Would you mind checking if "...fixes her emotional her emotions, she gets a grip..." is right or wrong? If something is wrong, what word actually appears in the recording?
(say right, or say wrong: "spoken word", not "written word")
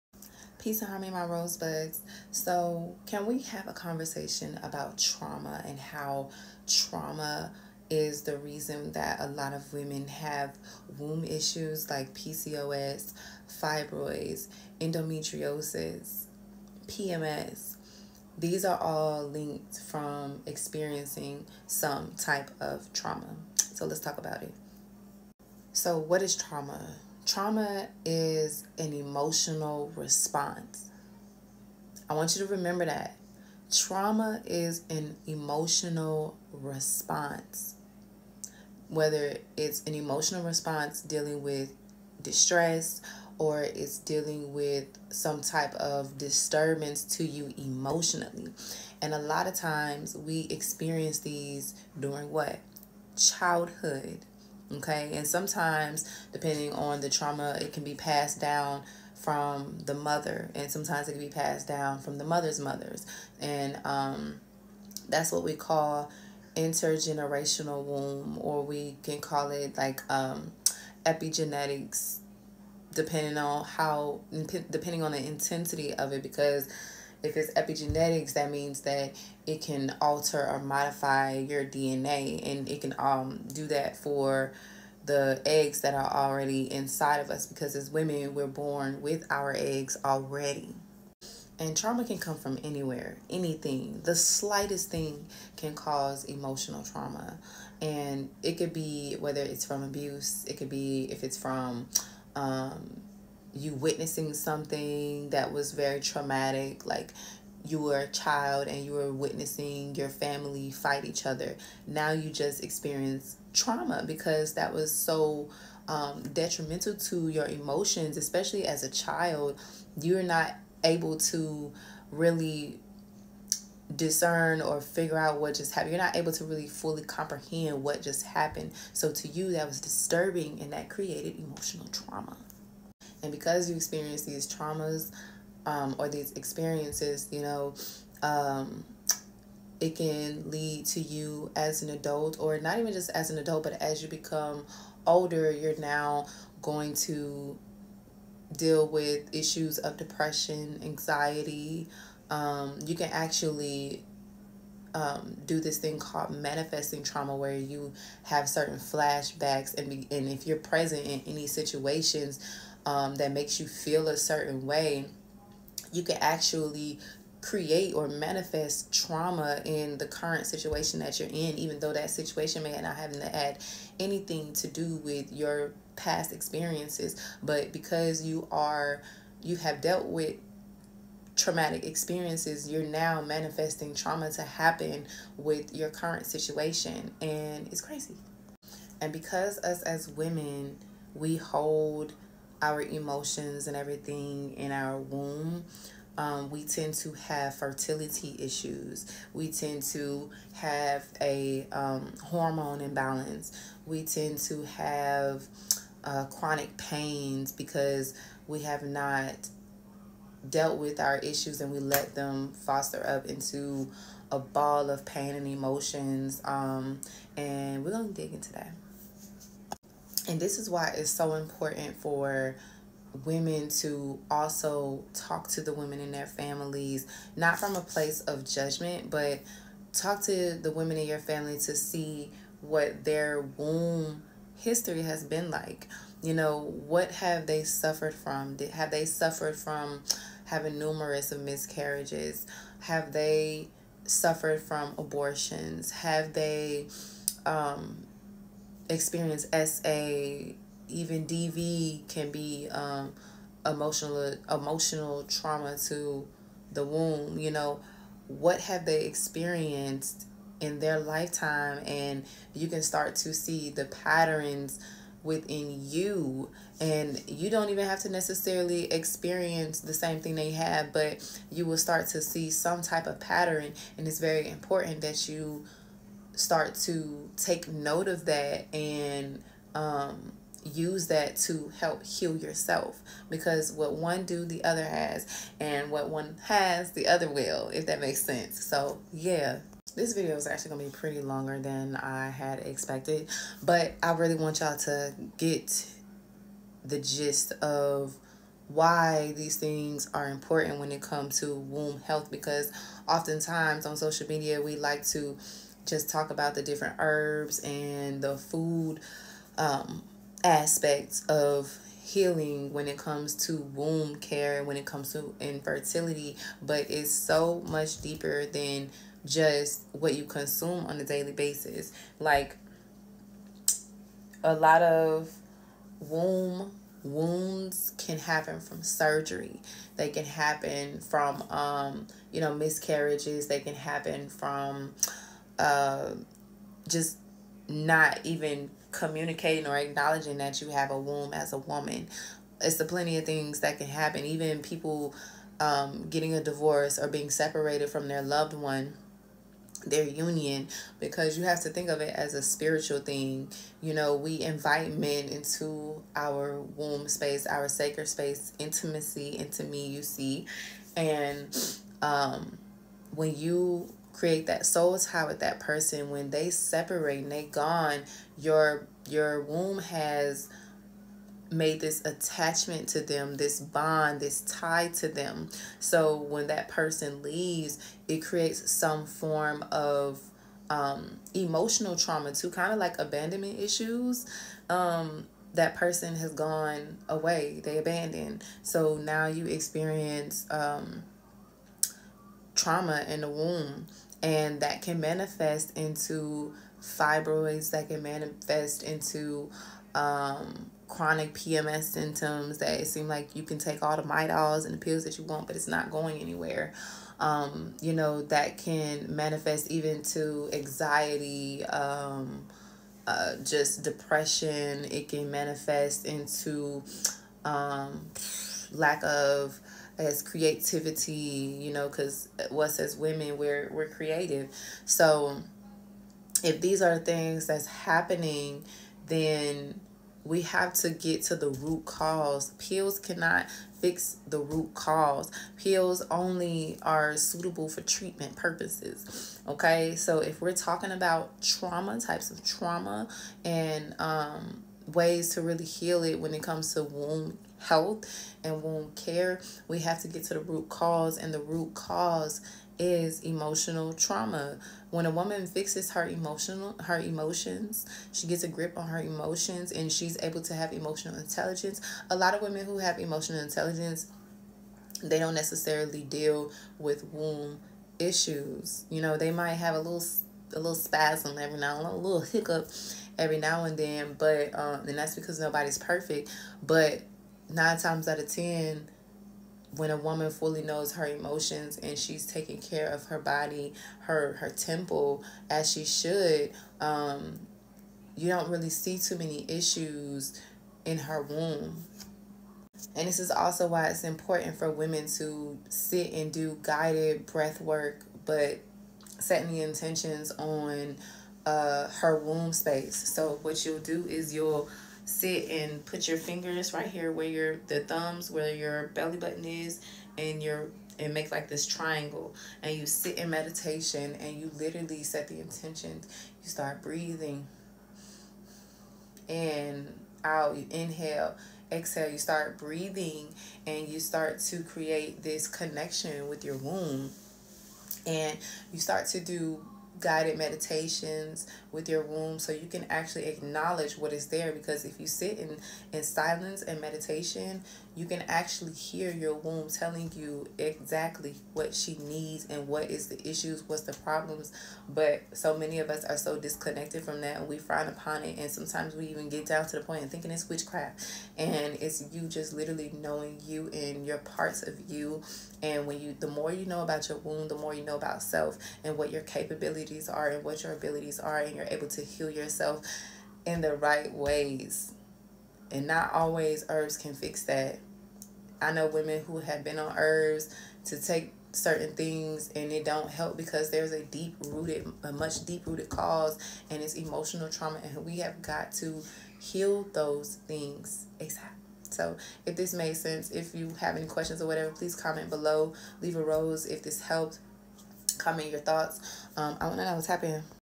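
right.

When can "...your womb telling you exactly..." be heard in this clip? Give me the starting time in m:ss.
8:59.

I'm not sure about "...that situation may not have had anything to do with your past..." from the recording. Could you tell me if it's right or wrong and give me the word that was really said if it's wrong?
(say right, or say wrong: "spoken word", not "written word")
right.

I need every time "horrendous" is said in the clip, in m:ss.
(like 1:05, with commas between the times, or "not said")
not said.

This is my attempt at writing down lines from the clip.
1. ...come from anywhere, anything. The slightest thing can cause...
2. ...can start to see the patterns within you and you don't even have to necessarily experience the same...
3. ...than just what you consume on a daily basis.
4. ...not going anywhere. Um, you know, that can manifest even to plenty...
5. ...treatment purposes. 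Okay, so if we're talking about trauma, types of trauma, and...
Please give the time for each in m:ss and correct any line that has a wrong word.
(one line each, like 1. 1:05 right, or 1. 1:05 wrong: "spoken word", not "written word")
1. 1:32 right
2. 4:22 right
3. 5:18 right
4. 6:45 wrong: "anxiety", not "plenty"
5. 7:17 right.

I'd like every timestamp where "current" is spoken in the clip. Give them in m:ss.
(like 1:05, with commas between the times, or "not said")
2:50, 3:05.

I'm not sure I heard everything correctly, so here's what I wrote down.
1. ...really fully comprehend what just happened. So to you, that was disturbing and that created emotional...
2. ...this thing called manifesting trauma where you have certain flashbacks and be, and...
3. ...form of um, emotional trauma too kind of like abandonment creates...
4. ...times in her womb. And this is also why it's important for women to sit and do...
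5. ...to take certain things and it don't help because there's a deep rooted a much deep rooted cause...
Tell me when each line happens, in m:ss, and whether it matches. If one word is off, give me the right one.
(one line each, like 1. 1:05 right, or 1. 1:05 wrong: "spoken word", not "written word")
1. 2:06 right
2. 2:35 right
3. 6:19 wrong: "issues", not "creates"
4. 8:09 wrong: "issues", not "times"
5. 9:30 right.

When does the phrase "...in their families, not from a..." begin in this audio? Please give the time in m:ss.
3:45.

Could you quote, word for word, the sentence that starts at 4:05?
Have they um, experience SA, even DV can be um, emotional emotional trauma to the womb.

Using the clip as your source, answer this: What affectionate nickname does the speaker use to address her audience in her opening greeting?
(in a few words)
rosebuds.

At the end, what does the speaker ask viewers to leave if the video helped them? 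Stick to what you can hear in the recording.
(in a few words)
a rose.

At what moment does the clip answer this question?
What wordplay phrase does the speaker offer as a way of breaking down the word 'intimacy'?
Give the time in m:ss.
5:58.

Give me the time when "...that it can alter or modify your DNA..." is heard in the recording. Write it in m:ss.
1:18.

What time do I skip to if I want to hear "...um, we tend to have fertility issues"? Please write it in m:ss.
3:16.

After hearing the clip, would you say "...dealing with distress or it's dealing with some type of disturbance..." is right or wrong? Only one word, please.
right.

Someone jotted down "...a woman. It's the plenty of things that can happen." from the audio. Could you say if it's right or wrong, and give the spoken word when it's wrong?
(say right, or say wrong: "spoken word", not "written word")
right.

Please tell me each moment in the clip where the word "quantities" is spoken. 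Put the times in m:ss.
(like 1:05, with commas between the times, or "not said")
not said.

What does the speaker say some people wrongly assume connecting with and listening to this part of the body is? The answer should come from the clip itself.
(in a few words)
witchcraft.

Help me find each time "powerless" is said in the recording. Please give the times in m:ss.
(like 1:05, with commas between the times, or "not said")
not said.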